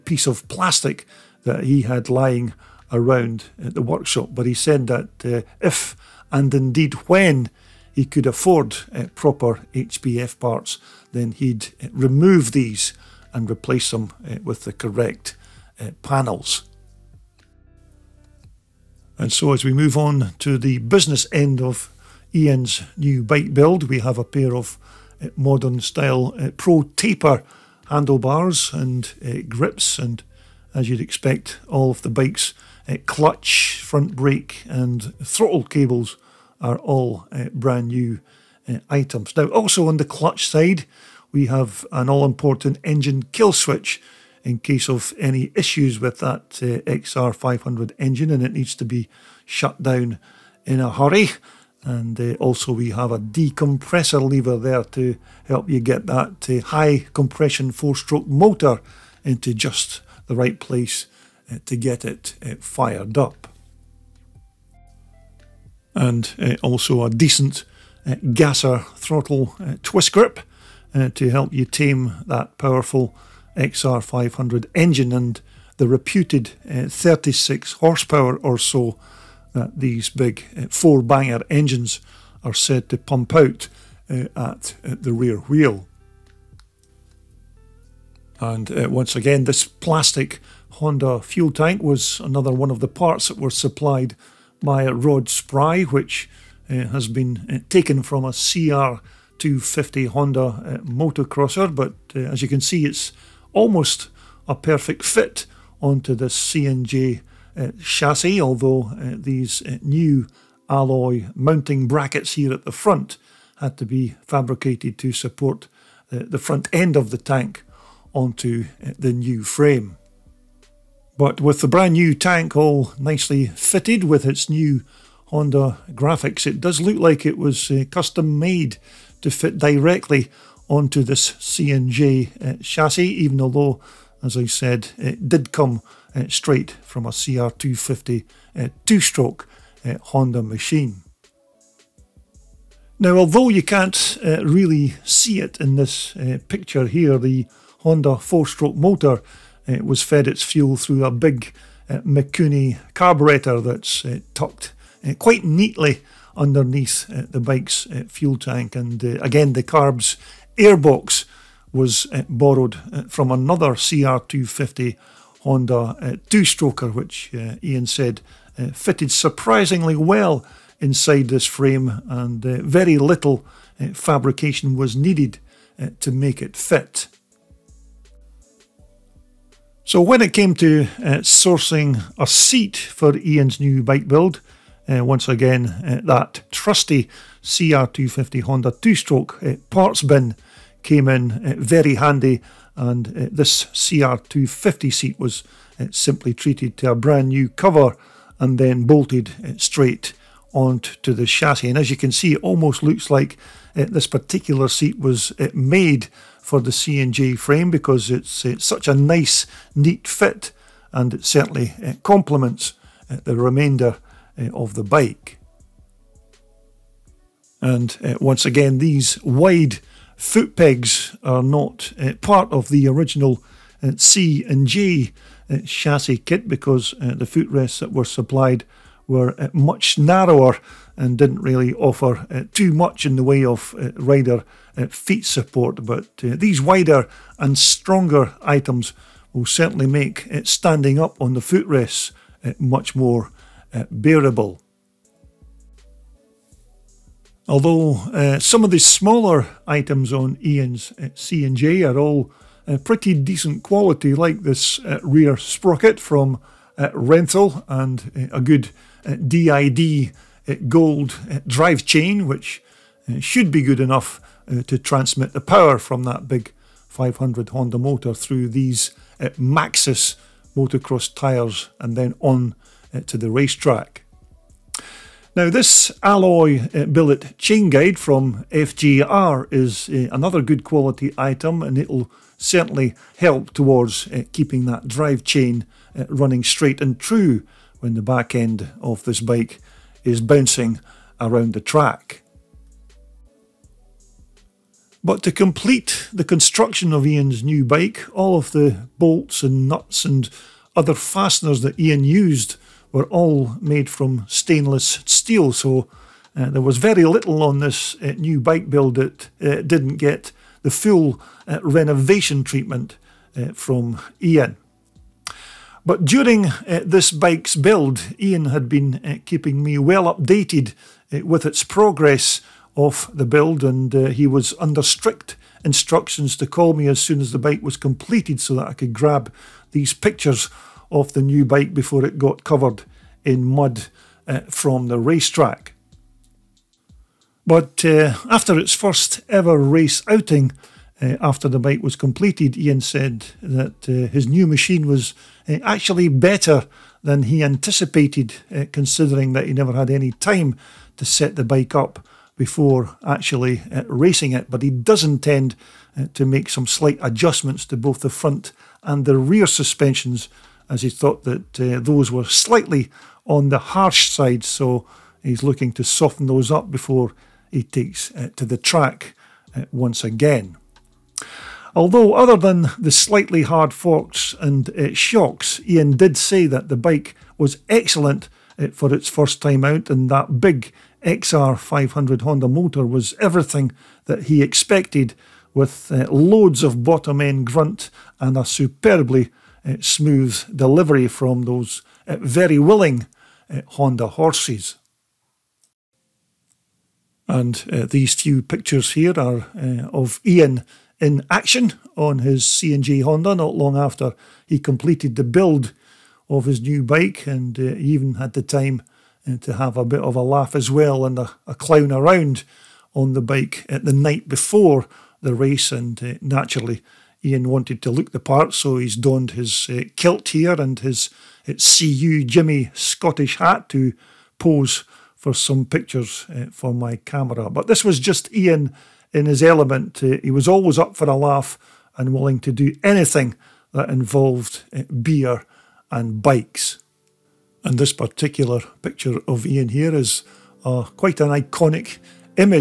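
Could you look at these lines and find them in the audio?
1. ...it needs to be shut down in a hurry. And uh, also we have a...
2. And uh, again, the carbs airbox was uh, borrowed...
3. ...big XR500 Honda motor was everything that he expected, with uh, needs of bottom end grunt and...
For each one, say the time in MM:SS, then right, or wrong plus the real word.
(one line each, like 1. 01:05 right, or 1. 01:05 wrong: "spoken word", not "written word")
1. 00:48 right
2. 02:38 right
3. 06:20 wrong: "loads", not "needs".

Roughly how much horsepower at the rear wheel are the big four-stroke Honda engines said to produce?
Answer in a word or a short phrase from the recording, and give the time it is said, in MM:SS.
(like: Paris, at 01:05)
36, at 01:16.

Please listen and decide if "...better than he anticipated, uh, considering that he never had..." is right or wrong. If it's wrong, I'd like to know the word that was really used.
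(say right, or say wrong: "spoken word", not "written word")
right.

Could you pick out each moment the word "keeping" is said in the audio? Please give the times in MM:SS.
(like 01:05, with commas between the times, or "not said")
04:44, 05:19.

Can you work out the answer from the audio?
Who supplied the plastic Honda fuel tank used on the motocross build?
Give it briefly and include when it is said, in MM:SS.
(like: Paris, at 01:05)
Rod Spry, at 01:34.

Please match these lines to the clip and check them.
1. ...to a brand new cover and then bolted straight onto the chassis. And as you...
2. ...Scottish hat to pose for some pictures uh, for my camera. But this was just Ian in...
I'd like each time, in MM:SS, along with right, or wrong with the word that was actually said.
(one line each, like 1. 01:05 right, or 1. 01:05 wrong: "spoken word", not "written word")
1. 03:16 right
2. 07:02 right.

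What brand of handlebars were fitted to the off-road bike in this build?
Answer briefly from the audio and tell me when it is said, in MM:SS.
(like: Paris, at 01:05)
Pro Taper, at 00:26.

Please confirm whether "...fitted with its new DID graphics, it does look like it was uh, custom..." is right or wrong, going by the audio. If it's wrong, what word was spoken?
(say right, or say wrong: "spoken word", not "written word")
wrong: "Honda", not "DID".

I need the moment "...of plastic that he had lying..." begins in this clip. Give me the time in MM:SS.
00:00.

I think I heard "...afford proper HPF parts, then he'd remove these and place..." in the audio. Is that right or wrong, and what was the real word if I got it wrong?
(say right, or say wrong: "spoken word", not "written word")
wrong: "replace", not "place".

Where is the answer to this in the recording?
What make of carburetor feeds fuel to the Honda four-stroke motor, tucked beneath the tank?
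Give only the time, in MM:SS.
02:31.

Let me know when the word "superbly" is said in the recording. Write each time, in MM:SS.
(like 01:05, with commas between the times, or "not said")
06:28.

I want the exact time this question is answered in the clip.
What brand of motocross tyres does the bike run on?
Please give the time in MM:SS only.
04:29.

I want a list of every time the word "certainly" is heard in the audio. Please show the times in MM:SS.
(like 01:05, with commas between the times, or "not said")
03:31, 03:59, 04:42.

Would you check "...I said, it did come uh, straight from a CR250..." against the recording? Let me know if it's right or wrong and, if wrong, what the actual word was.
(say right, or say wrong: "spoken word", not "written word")
right.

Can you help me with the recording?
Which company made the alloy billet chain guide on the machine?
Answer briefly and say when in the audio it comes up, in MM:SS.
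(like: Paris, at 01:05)
FGR, at 04:38.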